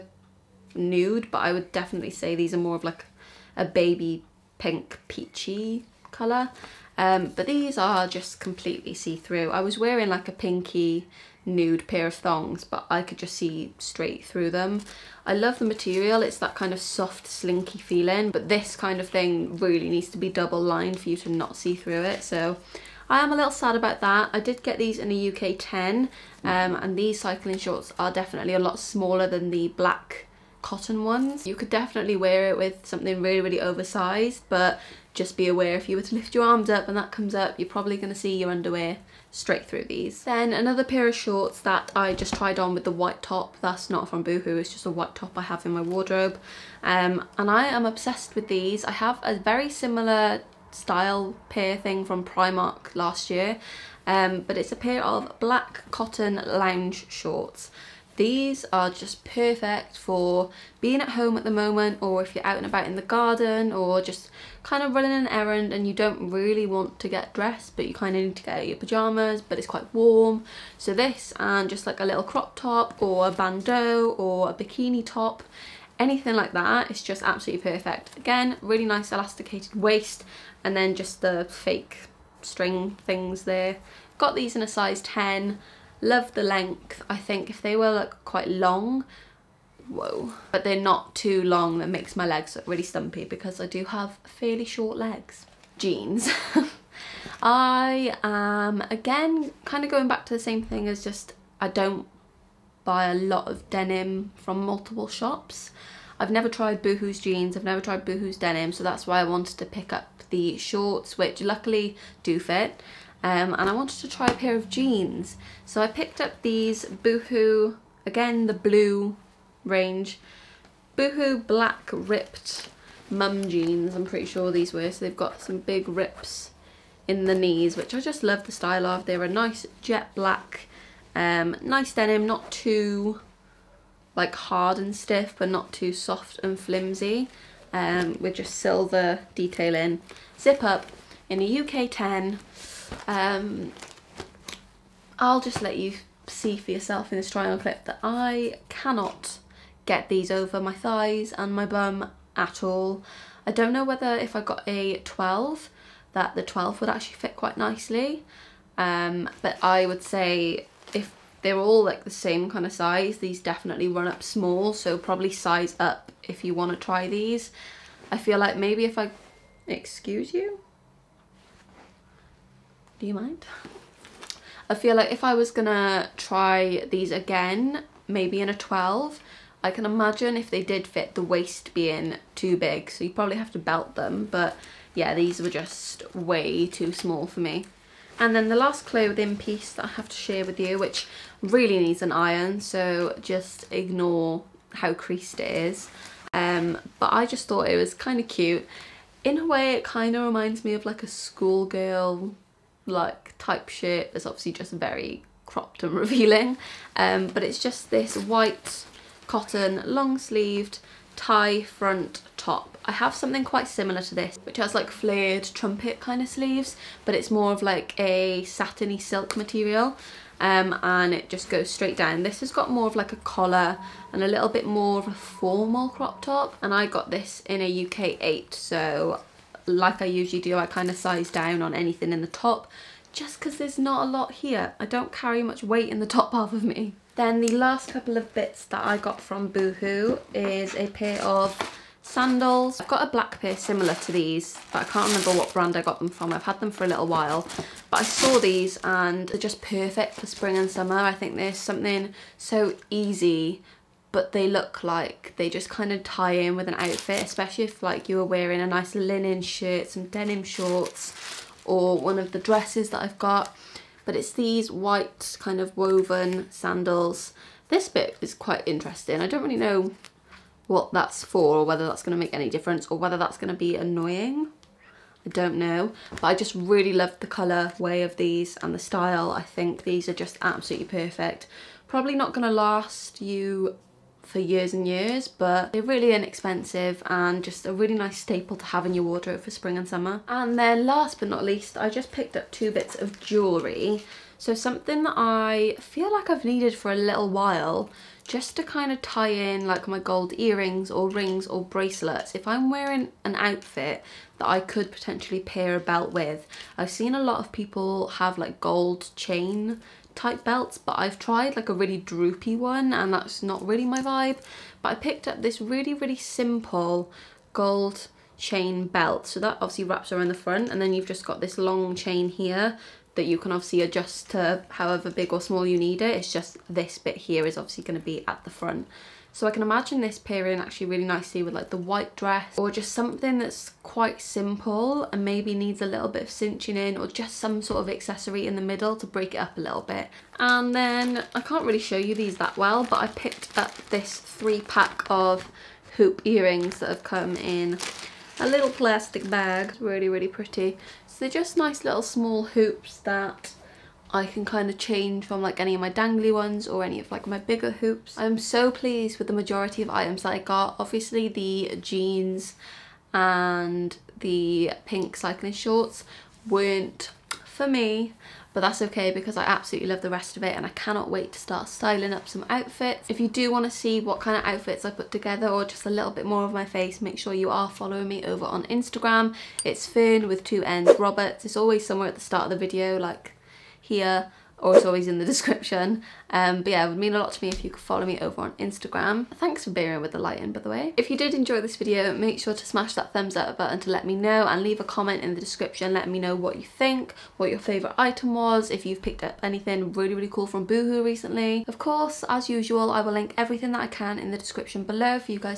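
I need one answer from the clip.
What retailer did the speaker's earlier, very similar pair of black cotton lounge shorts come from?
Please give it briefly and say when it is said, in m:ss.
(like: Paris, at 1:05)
Primark, at 0:52.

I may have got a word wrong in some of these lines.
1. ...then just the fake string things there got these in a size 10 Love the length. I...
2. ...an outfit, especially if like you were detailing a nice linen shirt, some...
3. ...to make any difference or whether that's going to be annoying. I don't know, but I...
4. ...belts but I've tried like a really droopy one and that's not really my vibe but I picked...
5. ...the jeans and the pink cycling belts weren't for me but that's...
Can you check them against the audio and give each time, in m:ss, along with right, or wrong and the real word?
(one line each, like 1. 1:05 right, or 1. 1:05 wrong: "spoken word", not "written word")
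1. 1:20 right
2. 4:16 wrong: "wearing", not "detailing"
3. 4:32 right
4. 5:10 right
5. 6:01 wrong: "shorts", not "belts".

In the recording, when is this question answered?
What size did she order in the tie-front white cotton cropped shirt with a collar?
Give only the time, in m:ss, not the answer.
3:47.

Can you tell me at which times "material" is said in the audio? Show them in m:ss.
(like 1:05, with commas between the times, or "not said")
0:15, 3:39.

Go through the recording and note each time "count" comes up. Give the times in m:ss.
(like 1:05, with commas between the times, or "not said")
not said.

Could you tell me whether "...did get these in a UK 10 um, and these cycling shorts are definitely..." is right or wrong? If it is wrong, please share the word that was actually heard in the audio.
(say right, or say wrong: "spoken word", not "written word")
right.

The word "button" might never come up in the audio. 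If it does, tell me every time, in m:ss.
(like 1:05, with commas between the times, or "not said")
6:33.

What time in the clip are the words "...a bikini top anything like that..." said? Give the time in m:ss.
1:14.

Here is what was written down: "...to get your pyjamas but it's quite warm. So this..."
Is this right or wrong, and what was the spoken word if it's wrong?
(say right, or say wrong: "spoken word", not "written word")
right.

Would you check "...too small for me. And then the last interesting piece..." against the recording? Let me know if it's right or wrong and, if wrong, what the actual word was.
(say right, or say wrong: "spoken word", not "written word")
wrong: "clothing", not "interesting".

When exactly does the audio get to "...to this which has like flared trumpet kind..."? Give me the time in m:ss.
3:34.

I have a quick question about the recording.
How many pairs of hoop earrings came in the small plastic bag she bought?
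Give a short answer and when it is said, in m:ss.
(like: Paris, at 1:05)
3, at 5:44.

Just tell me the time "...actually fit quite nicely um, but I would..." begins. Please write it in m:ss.
2:36.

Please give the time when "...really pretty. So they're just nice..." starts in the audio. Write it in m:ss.
5:50.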